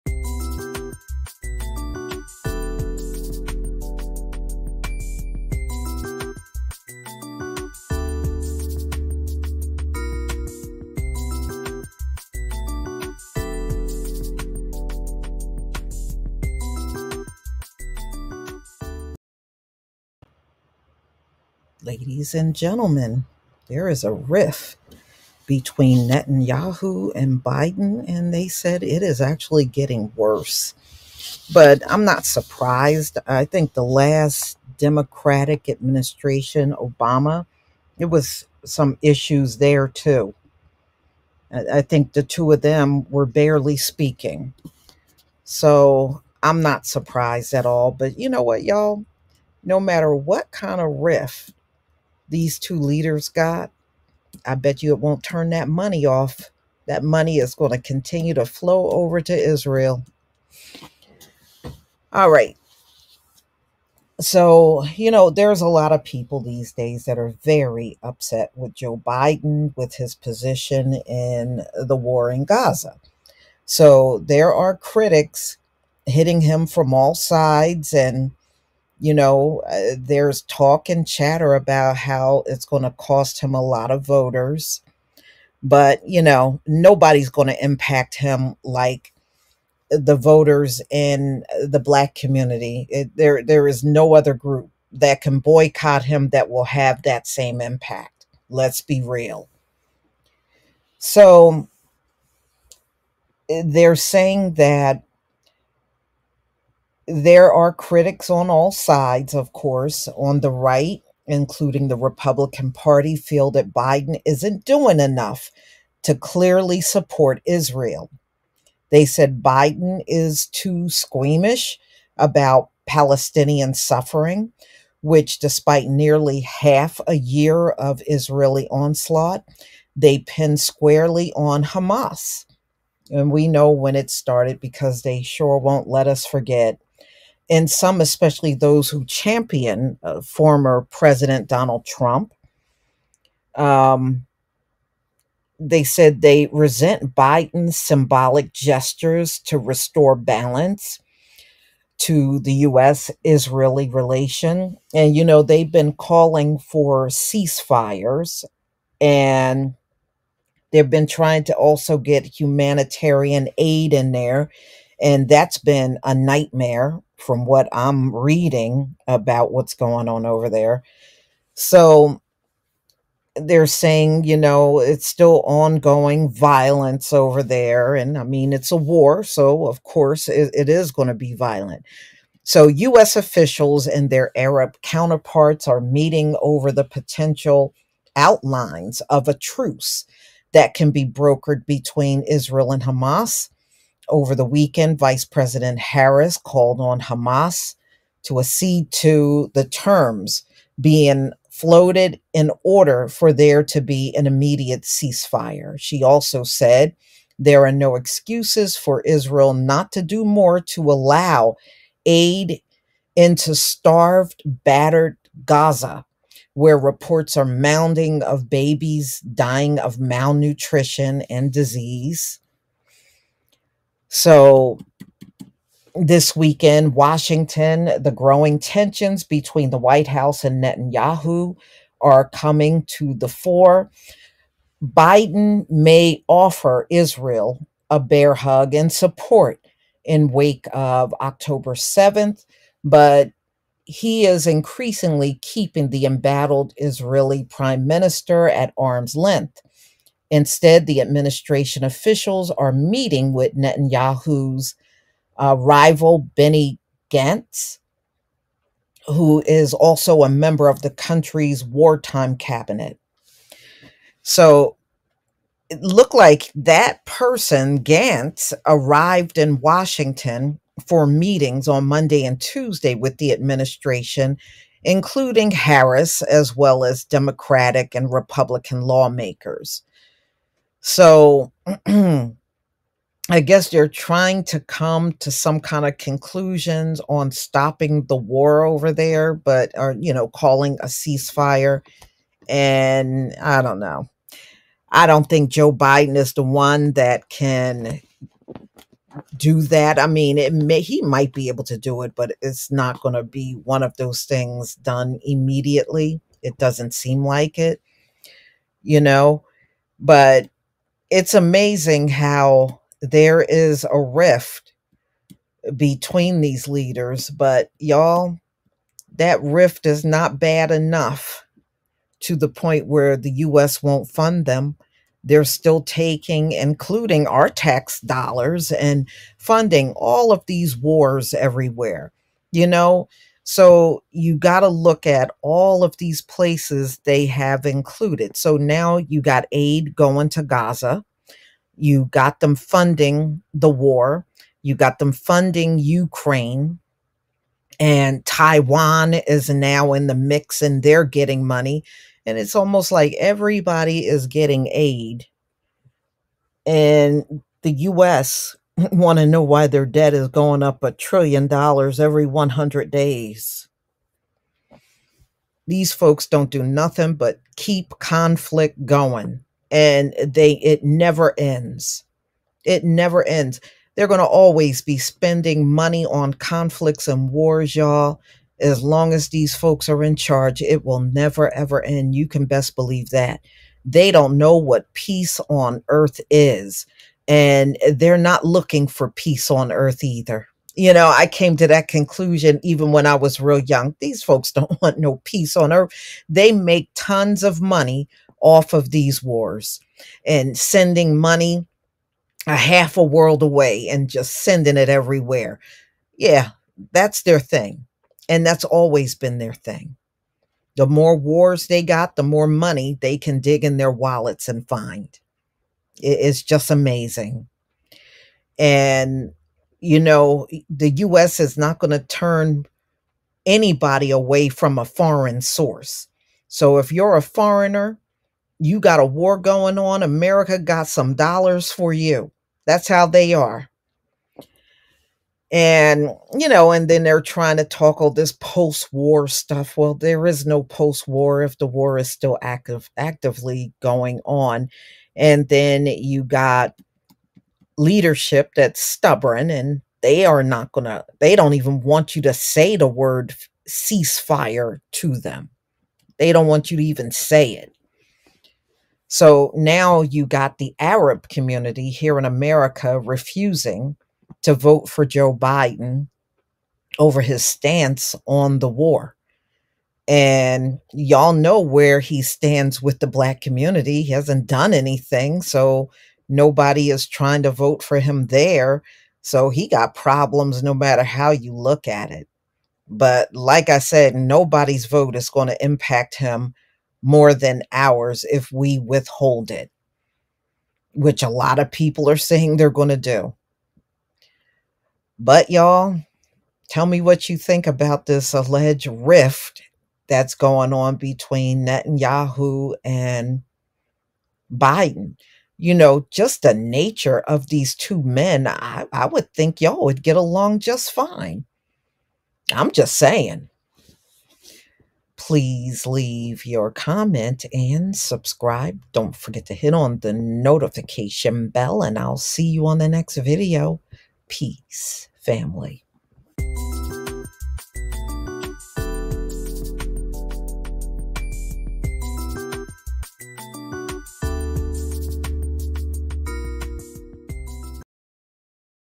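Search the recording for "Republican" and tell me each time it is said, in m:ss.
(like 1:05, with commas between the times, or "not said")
1:51, 4:38.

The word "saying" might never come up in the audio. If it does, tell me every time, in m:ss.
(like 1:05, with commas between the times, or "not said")
1:43, 2:53, 8:12, 8:32.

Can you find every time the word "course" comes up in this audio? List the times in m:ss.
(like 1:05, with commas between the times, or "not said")
1:49, 2:59.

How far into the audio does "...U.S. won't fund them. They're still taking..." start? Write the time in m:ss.
5:23.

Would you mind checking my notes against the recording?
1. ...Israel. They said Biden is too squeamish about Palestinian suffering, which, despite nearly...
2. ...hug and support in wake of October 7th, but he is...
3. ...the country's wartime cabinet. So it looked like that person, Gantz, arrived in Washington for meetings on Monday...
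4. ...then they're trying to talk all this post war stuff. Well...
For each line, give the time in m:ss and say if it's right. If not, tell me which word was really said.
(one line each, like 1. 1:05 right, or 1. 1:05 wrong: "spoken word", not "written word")
1. 1:57 right
2. 3:58 right
3. 4:20 right
4. 7:16 right.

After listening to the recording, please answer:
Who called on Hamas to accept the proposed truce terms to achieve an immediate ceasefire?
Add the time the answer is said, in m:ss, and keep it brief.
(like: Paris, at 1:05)
Vice President Harris, at 3:14.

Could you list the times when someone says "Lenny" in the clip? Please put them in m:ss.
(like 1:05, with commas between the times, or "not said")
not said.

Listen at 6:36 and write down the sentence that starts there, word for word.
They make tons of money off of these wars and sending money a half a world away and just sending it everywhere.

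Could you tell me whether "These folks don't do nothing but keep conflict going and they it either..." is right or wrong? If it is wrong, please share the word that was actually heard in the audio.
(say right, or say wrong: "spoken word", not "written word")
wrong: "never", not "either".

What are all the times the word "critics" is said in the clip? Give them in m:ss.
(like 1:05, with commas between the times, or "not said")
1:14, 1:47.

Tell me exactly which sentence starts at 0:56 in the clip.
That money is going to continue to flow over to Israel.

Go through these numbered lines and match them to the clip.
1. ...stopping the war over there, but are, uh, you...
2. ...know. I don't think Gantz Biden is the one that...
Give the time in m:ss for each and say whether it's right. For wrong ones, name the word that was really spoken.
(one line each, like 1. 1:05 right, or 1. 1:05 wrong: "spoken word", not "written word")
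1. 4:47 right
2. 4:53 wrong: "Joe", not "Gantz".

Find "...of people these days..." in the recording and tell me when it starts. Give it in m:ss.
1:05.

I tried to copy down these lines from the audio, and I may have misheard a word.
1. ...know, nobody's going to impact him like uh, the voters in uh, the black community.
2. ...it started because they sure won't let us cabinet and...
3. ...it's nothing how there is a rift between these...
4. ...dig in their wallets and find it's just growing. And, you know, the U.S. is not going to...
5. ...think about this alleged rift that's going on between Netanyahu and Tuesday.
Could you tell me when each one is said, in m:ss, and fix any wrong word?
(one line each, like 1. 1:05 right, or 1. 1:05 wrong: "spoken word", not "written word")
1. 1:26 right
2. 2:13 wrong: "forget", not "cabinet"
3. 5:11 wrong: "amazing", not "nothing"
4. 6:53 wrong: "amazing", not "growing"
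5. 8:17 wrong: "Biden", not "Tuesday".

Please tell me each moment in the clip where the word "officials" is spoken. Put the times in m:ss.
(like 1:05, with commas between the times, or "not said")
3:03, 4:11.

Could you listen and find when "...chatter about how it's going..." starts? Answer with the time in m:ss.
1:21.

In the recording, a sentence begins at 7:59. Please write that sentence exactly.
So he got problems no matter how you look at it.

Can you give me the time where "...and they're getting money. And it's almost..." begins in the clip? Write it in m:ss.
5:50.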